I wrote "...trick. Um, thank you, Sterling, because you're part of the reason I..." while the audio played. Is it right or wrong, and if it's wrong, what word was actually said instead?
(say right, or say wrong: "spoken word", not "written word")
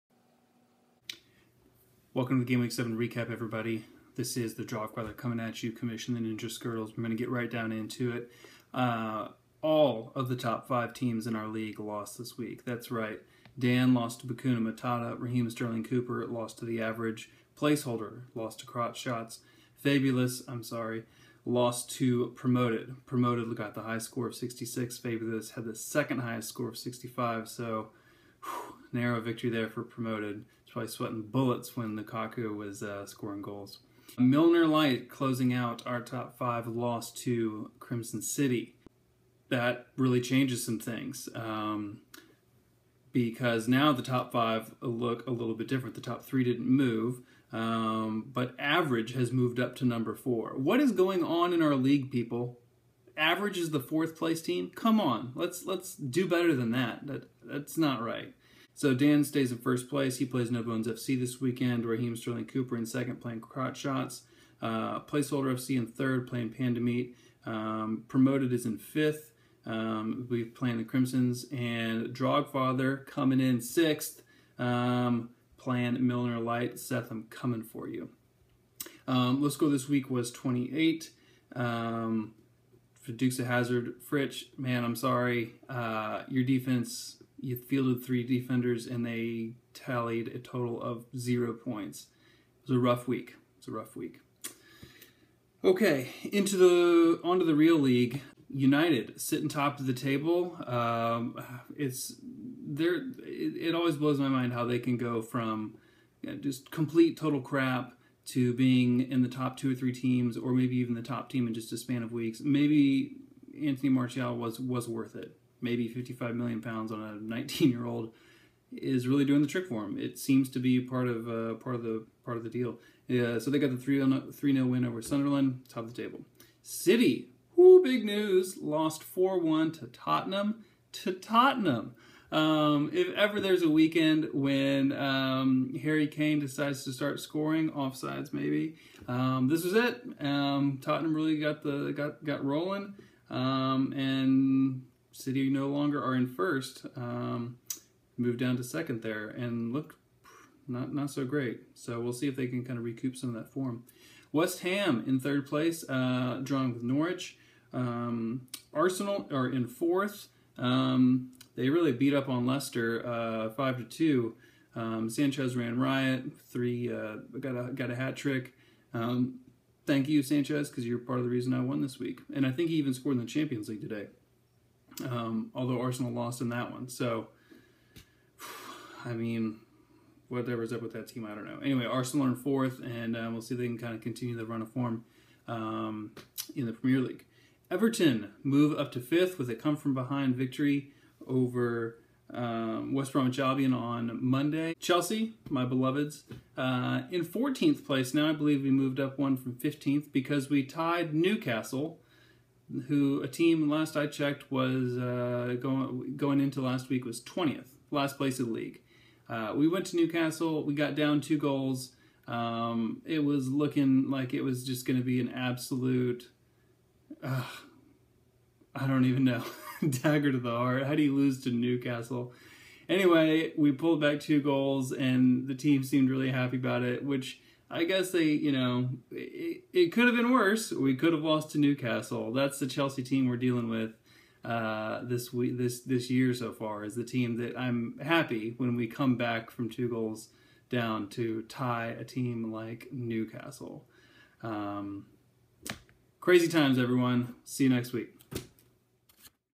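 wrong: "Sanchez", not "Sterling".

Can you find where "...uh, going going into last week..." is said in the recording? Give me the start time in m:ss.
3:24.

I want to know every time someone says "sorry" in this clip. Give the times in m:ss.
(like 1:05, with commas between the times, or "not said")
0:20, 1:24.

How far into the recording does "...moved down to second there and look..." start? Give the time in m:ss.
2:28.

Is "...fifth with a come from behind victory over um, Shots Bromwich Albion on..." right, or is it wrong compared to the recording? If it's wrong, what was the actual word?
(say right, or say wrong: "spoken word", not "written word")
wrong: "West", not "Shots".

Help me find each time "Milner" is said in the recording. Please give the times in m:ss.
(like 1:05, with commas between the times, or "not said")
0:34, 1:16.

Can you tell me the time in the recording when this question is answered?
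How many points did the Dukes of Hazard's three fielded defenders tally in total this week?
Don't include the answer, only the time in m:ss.
1:31.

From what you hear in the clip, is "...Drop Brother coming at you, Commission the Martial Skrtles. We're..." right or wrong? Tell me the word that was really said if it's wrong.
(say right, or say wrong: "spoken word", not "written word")
wrong: "Ninja", not "Martial".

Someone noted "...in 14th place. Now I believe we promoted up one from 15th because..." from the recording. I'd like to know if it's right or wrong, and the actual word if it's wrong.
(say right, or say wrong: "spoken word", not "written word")
wrong: "moved", not "promoted".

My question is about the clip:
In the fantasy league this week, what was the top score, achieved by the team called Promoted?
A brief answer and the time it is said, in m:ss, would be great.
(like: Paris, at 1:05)
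66, at 0:24.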